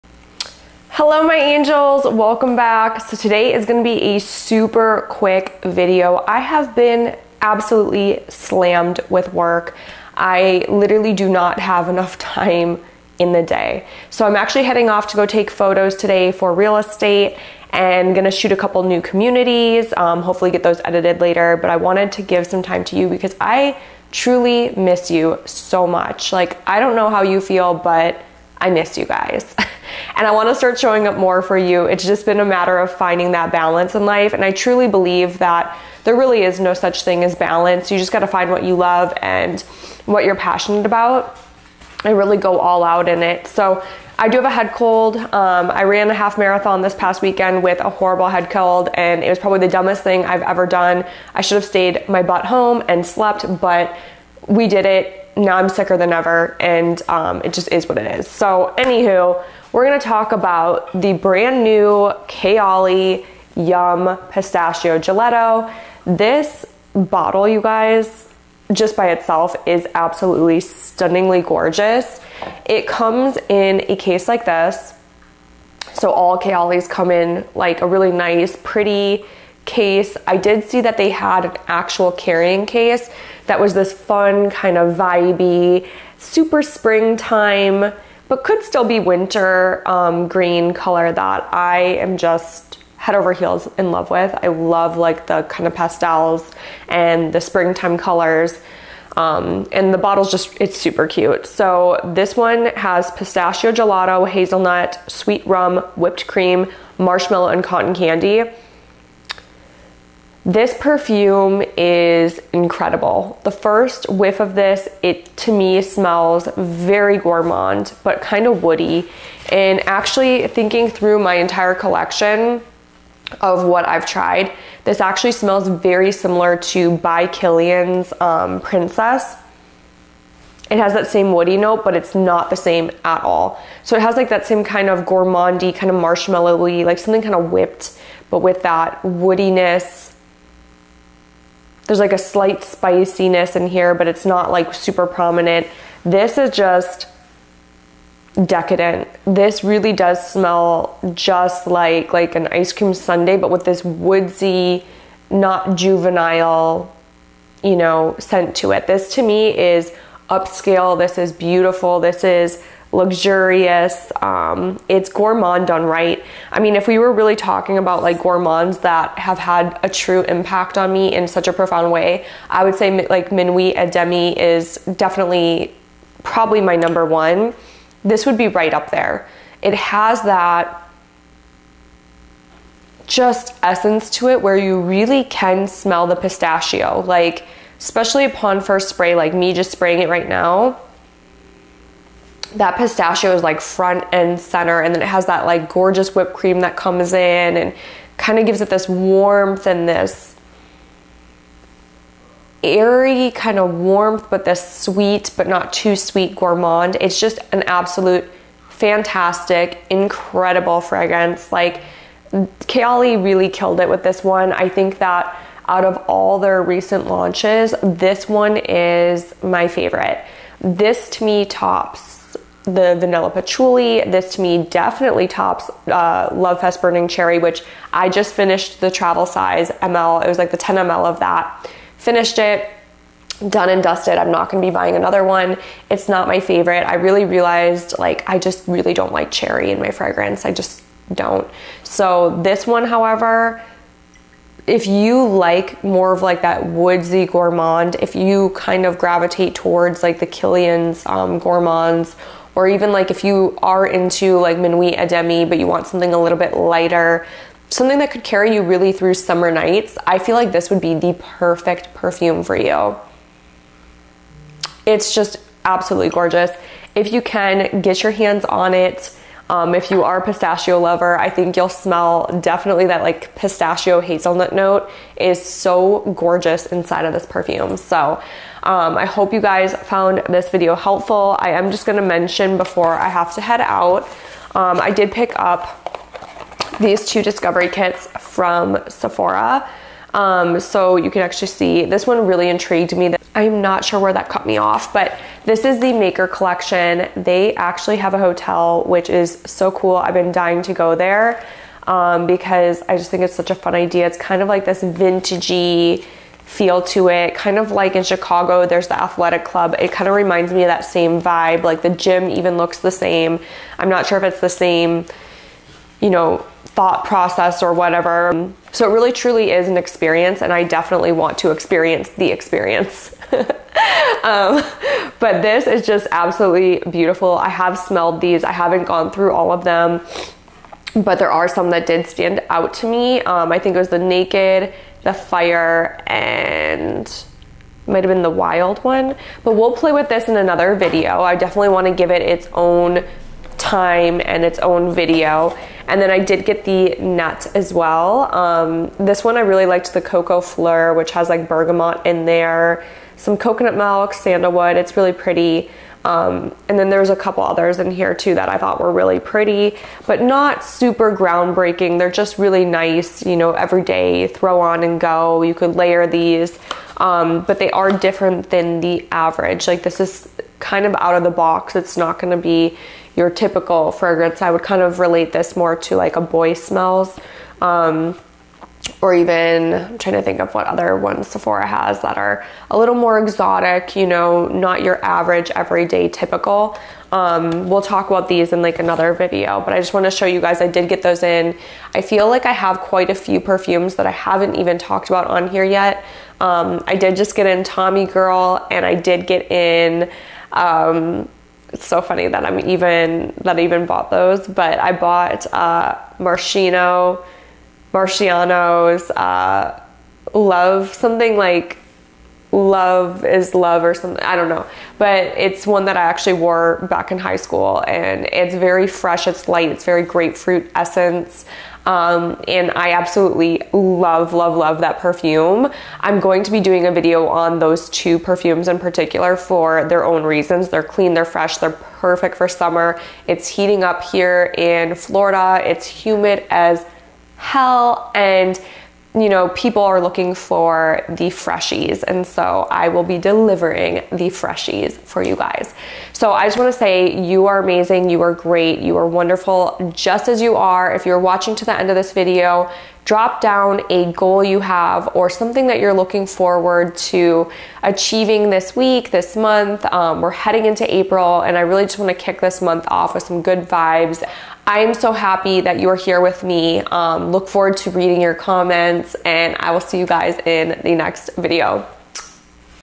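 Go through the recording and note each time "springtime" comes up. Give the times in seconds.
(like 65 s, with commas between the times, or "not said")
86 s, 97 s.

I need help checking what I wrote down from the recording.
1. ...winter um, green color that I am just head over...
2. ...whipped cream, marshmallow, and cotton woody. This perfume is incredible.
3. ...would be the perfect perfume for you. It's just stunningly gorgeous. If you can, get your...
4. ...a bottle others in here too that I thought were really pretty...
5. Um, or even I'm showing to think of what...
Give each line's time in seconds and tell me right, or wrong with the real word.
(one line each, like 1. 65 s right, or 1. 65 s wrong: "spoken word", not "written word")
1. 89 s right
2. 105 s wrong: "candy", not "woody"
3. 260 s wrong: "absolutely", not "stunningly"
4. 357 s wrong: "couple", not "bottle"
5. 377 s wrong: "trying", not "showing".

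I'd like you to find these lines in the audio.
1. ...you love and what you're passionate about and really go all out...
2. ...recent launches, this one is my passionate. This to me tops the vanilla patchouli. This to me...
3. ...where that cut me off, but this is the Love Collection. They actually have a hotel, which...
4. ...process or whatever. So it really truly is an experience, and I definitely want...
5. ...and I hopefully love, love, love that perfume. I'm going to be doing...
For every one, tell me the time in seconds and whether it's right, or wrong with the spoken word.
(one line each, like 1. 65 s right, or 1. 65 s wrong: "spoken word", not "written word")
1. 38 s right
2. 216 s wrong: "favorite", not "passionate"
3. 293 s wrong: "Maker", not "Love"
4. 317 s right
5. 422 s wrong: "absolutely", not "hopefully".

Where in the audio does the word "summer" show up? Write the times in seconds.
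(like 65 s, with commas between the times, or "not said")
259 s, 432 s.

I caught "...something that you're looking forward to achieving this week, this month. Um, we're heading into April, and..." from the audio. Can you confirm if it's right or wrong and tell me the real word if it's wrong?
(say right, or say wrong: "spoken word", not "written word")
right.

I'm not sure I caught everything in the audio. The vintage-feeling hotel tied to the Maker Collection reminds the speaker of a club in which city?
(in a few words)
Chicago.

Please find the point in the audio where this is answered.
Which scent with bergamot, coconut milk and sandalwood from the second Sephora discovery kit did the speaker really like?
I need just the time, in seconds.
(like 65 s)
350 s.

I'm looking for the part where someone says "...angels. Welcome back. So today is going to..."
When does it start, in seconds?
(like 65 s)
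1 s.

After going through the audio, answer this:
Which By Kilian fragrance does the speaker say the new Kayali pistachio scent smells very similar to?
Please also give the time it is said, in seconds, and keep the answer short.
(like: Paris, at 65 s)
Princess, at 128 s.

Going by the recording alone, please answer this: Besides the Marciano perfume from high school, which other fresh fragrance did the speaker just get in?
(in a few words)
Tommy Girl.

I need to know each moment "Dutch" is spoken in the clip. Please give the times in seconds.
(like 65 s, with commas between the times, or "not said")
not said.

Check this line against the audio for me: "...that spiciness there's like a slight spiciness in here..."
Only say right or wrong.
wrong.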